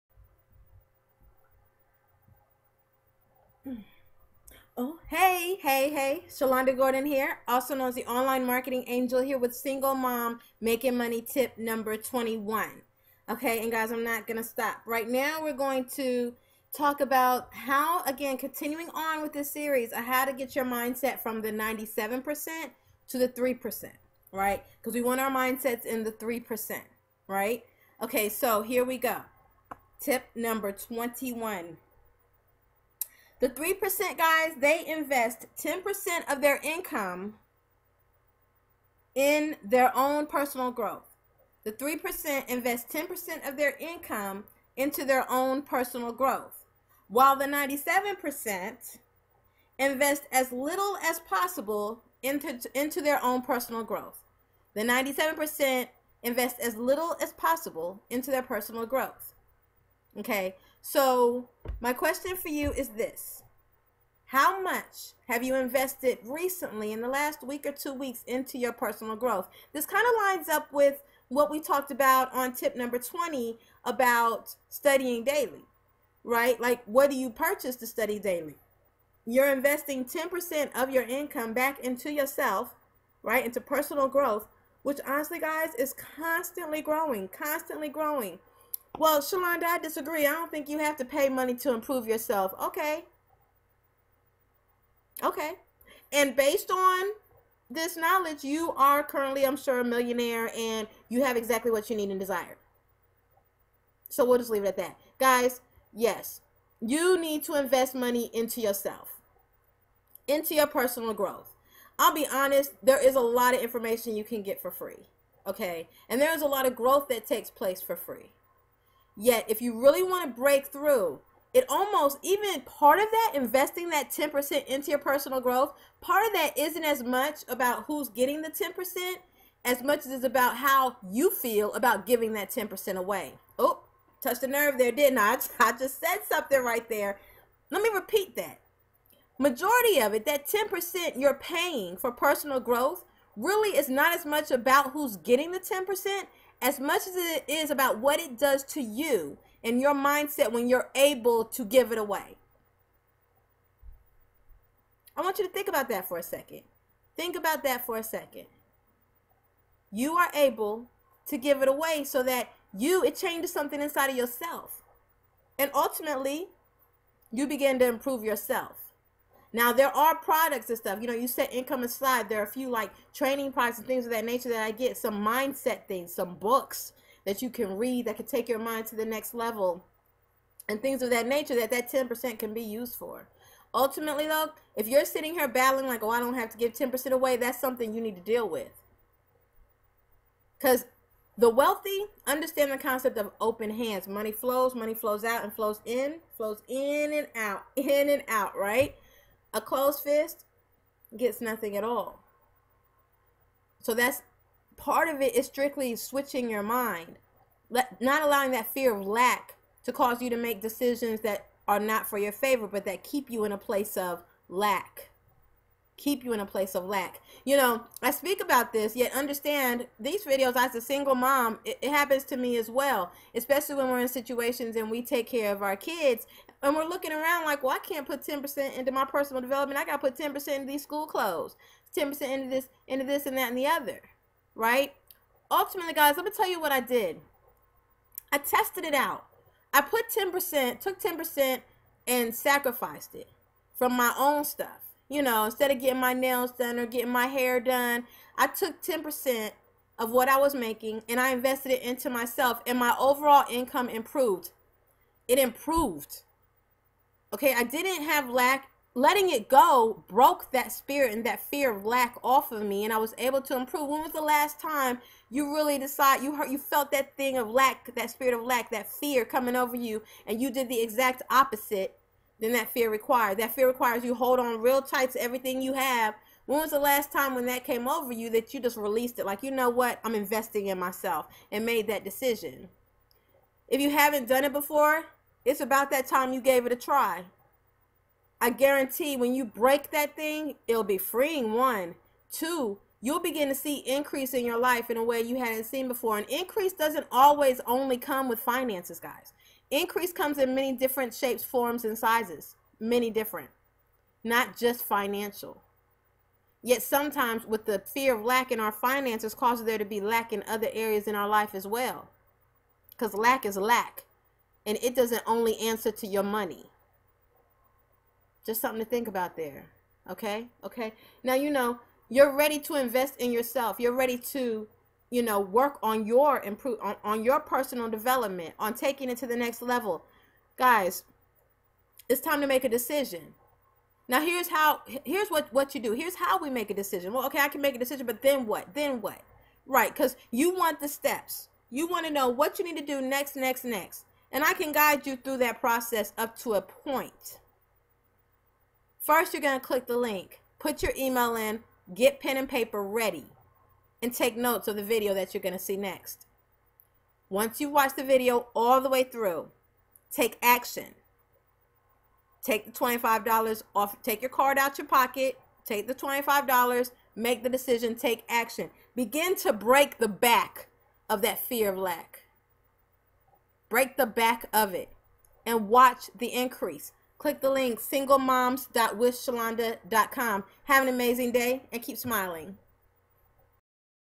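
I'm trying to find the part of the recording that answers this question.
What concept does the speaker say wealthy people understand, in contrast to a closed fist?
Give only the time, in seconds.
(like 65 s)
193 s.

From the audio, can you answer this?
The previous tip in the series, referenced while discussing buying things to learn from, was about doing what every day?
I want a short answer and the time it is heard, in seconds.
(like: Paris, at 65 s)
Studying daily, at 74 s.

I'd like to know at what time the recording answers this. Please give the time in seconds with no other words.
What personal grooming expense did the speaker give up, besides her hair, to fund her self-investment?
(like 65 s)
246 s.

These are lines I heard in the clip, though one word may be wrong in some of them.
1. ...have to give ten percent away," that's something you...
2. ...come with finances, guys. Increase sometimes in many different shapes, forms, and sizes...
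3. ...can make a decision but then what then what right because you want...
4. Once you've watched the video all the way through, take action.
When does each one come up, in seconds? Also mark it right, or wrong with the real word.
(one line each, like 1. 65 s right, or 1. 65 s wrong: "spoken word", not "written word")
1. 186 s right
2. 297 s wrong: "comes", not "sometimes"
3. 337 s right
4. 357 s right.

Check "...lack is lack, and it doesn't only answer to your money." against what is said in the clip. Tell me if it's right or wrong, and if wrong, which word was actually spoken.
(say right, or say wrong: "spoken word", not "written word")
right.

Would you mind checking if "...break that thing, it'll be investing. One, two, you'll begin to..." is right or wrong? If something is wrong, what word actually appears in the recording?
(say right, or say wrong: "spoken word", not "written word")
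wrong: "freeing", not "investing".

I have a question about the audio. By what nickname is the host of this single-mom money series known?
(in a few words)
Online Marketing Angel.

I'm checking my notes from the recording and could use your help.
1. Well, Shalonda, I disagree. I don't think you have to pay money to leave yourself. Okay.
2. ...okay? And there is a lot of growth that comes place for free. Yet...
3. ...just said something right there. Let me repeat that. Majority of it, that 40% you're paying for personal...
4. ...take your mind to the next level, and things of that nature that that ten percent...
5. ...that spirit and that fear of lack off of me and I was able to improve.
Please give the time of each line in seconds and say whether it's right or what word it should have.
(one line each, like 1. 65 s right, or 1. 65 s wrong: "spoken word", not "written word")
1. 89 s wrong: "improve", not "leave"
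2. 115 s wrong: "takes", not "comes"
3. 135 s wrong: "10", not "40"
4. 178 s right
5. 260 s right.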